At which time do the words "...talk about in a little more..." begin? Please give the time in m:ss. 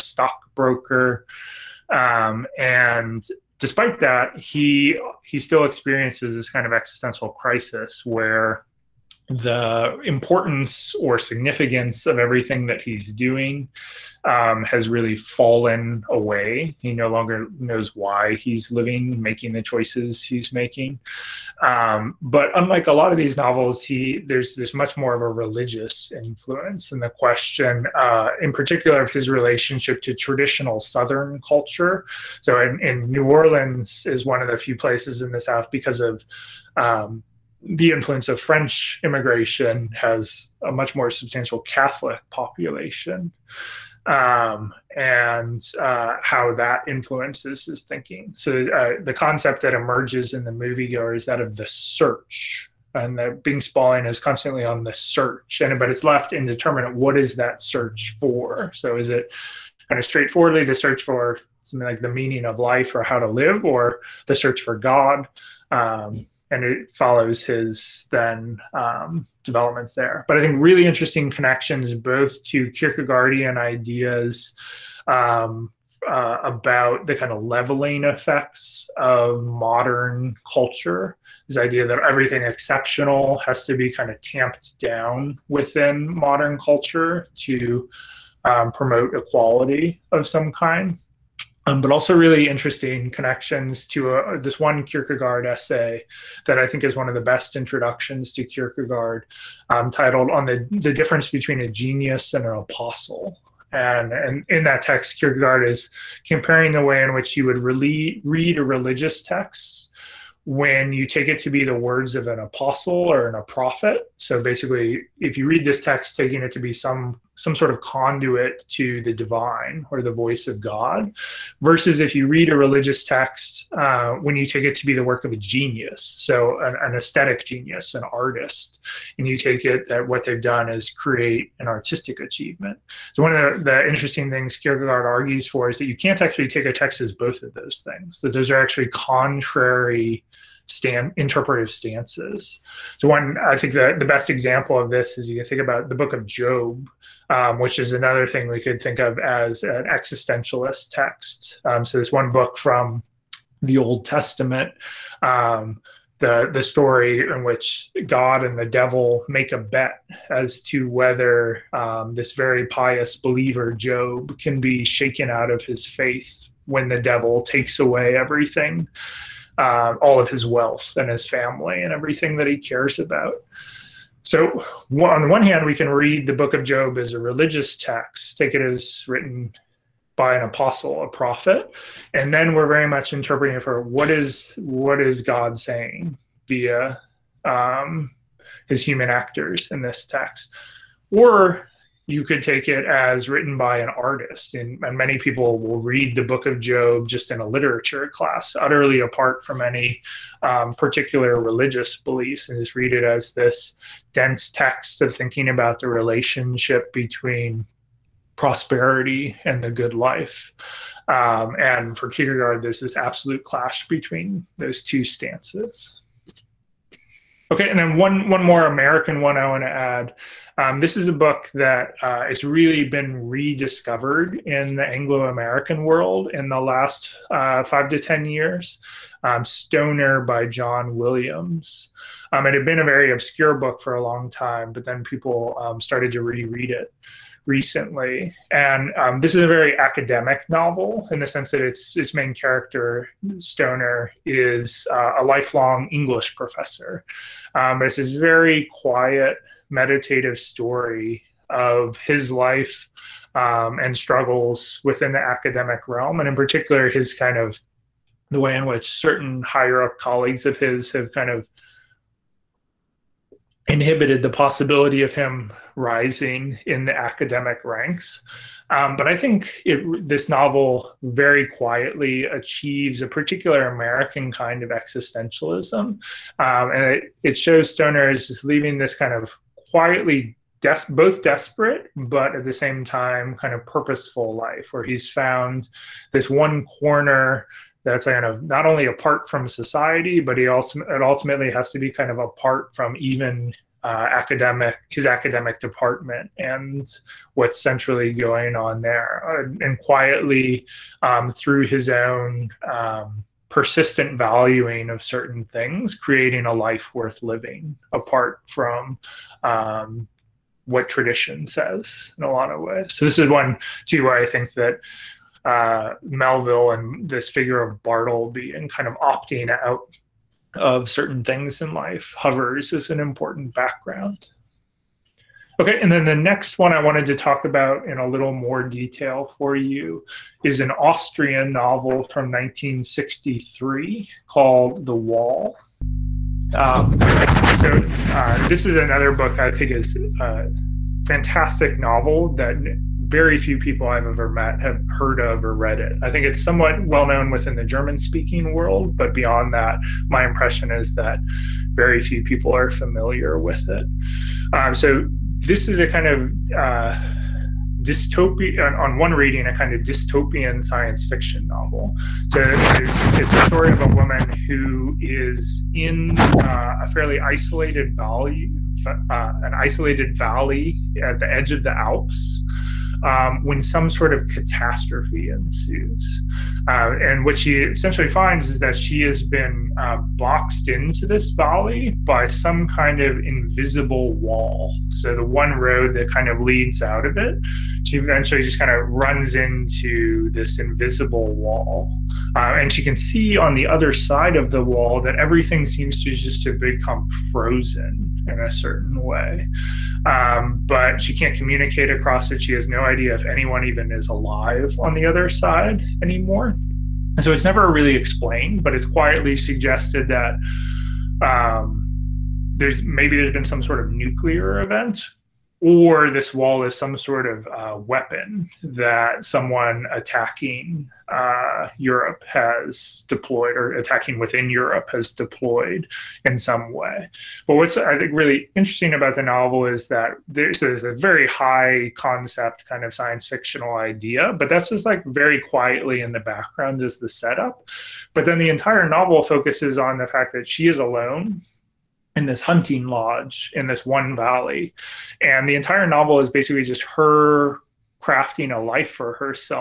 5:27.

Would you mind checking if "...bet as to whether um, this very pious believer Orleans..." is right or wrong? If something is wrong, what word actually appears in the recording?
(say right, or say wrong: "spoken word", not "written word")
wrong: "Job", not "Orleans".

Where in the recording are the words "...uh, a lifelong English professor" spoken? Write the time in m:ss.
4:04.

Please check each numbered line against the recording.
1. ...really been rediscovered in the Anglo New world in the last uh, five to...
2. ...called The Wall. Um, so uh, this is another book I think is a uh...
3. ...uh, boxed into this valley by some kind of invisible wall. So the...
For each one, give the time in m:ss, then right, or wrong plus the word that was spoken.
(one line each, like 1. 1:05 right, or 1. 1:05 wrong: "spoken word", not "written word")
1. 3:42 wrong: "American", not "New"
2. 5:34 right
3. 6:19 right.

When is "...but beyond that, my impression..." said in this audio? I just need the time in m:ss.
5:48.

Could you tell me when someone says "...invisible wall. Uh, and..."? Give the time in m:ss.
6:30.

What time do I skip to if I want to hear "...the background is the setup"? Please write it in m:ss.
7:16.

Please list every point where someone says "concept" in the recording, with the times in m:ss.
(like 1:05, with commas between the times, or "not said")
0:49, 7:11.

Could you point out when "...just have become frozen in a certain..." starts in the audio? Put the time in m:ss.
6:36.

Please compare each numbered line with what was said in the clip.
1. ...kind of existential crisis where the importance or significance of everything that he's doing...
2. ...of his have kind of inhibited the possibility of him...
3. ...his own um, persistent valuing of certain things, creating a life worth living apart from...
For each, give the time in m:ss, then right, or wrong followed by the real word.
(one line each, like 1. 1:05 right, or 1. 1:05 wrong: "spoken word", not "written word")
1. 0:06 right
2. 4:20 right
3. 5:01 right.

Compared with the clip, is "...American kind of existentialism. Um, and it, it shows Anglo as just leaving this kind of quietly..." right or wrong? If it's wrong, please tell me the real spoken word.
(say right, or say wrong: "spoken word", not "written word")
wrong: "Stoner", not "Anglo".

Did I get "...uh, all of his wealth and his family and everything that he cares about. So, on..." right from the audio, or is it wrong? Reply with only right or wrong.
right.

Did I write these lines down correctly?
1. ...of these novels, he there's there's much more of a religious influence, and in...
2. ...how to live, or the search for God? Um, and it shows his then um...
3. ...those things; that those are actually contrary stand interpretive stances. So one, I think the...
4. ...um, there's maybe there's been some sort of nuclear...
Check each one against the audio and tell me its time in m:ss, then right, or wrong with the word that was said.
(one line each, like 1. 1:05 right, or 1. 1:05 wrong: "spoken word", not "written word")
1. 0:23 right
2. 1:03 wrong: "follows", not "shows"
3. 2:17 right
4. 6:51 right.